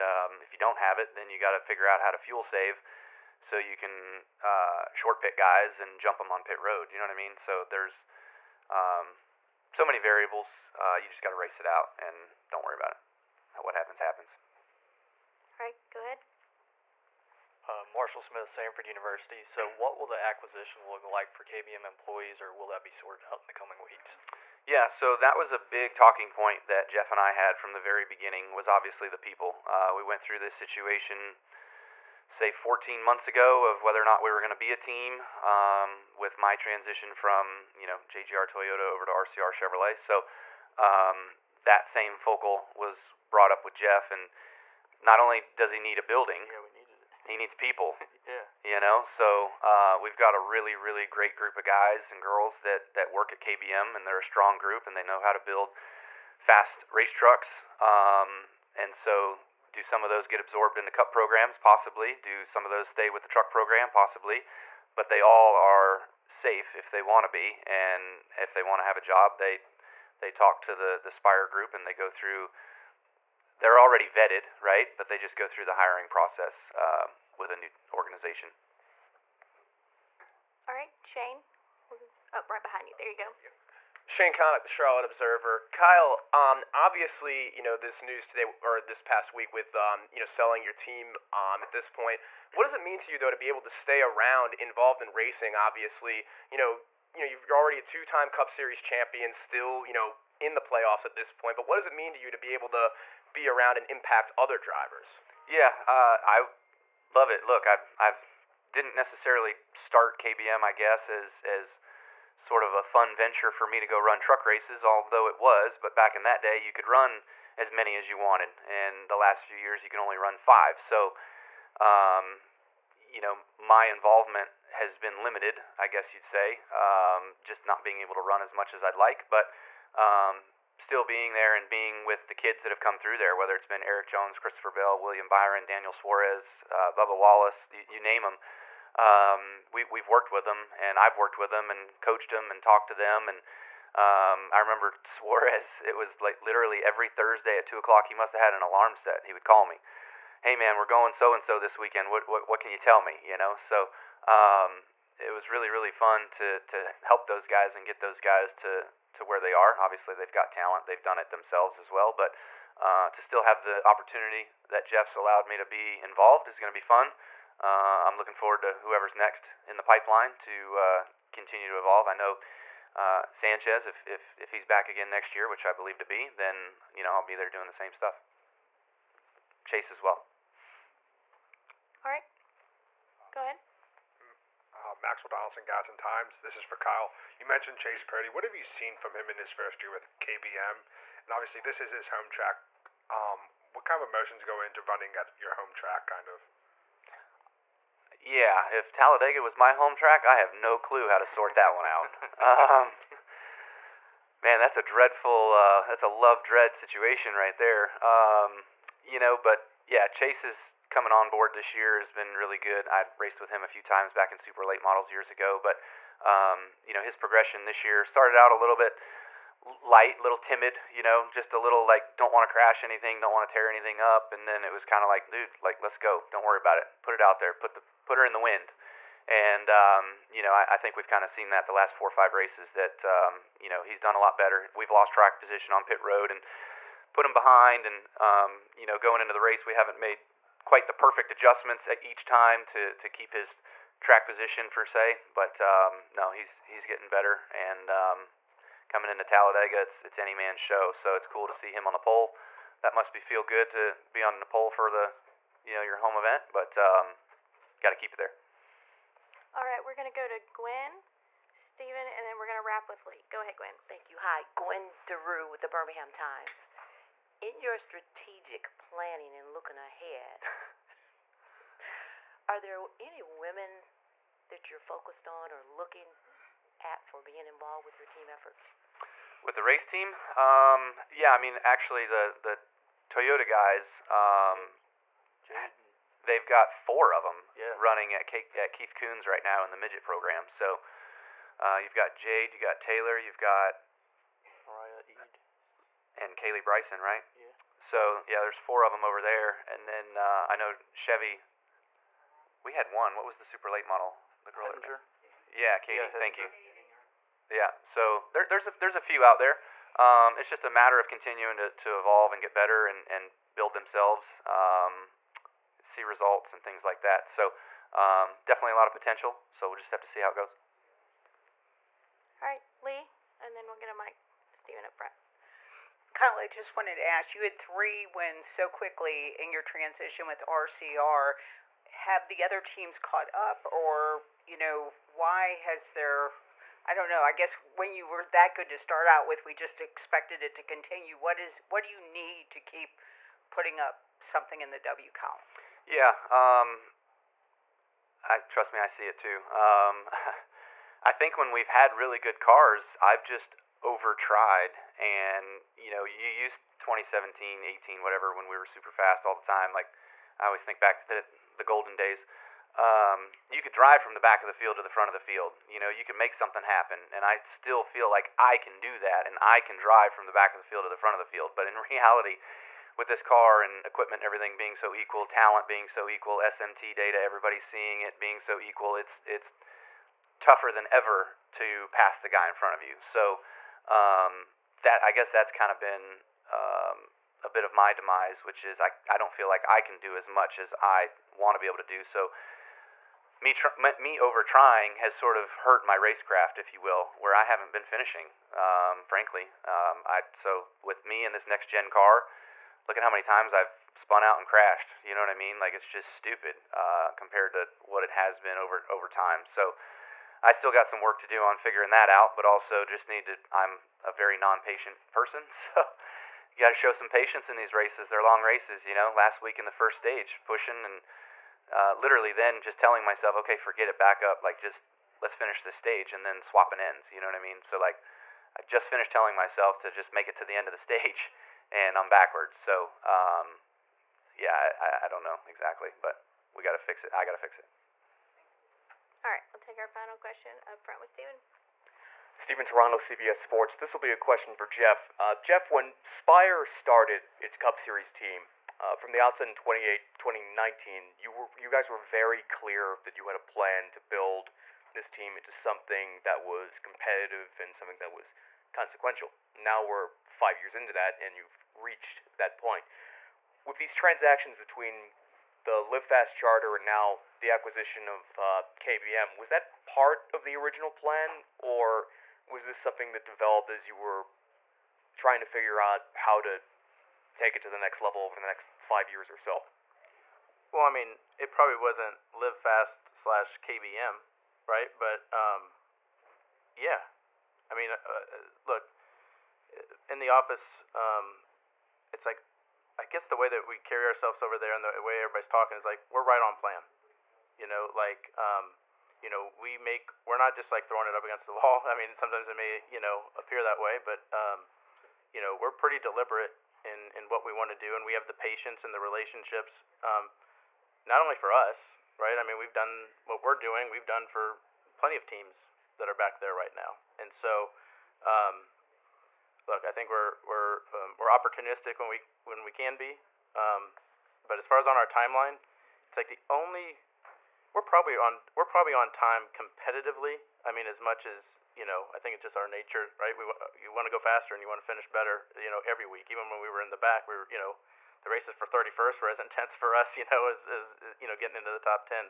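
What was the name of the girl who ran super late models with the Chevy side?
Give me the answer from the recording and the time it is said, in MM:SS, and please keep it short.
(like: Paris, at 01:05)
Katie, at 05:05.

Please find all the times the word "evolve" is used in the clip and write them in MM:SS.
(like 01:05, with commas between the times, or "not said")
02:51, 05:11.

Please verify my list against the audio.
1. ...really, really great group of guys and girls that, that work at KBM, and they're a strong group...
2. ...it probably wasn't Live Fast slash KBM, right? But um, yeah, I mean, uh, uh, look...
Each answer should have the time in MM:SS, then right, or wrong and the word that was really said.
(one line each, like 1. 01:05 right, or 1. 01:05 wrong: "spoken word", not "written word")
1. 00:50 right
2. 08:01 right.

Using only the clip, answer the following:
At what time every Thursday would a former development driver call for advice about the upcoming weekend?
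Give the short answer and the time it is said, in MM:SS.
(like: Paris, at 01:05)
2 o'clock, at 02:27.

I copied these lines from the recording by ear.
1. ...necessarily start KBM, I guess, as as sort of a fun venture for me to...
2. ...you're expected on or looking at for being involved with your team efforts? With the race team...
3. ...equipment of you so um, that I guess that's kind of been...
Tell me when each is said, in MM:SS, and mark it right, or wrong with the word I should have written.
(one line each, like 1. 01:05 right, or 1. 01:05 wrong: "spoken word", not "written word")
1. 01:48 right
2. 04:34 wrong: "focused", not "expected"
3. 06:22 wrong: "front", not "equipment".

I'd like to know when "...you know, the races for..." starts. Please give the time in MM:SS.
08:57.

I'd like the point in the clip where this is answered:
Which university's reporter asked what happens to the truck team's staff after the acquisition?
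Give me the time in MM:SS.
00:18.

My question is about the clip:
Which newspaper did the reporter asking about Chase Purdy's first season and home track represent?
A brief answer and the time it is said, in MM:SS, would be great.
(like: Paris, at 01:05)
Gadsden Times, at 03:05.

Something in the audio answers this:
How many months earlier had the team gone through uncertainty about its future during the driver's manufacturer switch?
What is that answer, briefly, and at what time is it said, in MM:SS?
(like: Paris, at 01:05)
14, at 00:32.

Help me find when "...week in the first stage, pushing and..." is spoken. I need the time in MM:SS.
06:59.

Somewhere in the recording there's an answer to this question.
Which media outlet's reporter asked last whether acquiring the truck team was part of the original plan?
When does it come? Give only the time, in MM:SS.
07:22.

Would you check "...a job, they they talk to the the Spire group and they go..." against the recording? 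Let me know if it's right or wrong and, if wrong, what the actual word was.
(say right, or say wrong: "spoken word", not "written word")
right.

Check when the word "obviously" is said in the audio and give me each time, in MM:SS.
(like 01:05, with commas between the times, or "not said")
00:28, 01:26, 01:35, 02:39, 03:11.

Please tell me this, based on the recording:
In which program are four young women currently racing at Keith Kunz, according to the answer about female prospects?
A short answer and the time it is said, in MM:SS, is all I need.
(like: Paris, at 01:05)
midget program, at 04:49.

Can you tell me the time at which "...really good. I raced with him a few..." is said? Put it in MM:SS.
03:32.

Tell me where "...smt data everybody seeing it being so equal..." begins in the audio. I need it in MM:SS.
06:16.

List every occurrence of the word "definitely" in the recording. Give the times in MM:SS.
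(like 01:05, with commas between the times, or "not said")
05:18.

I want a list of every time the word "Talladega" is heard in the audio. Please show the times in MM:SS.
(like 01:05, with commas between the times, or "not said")
03:18, 04:09.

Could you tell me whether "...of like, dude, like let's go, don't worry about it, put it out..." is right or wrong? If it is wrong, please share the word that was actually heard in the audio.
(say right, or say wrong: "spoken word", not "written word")
right.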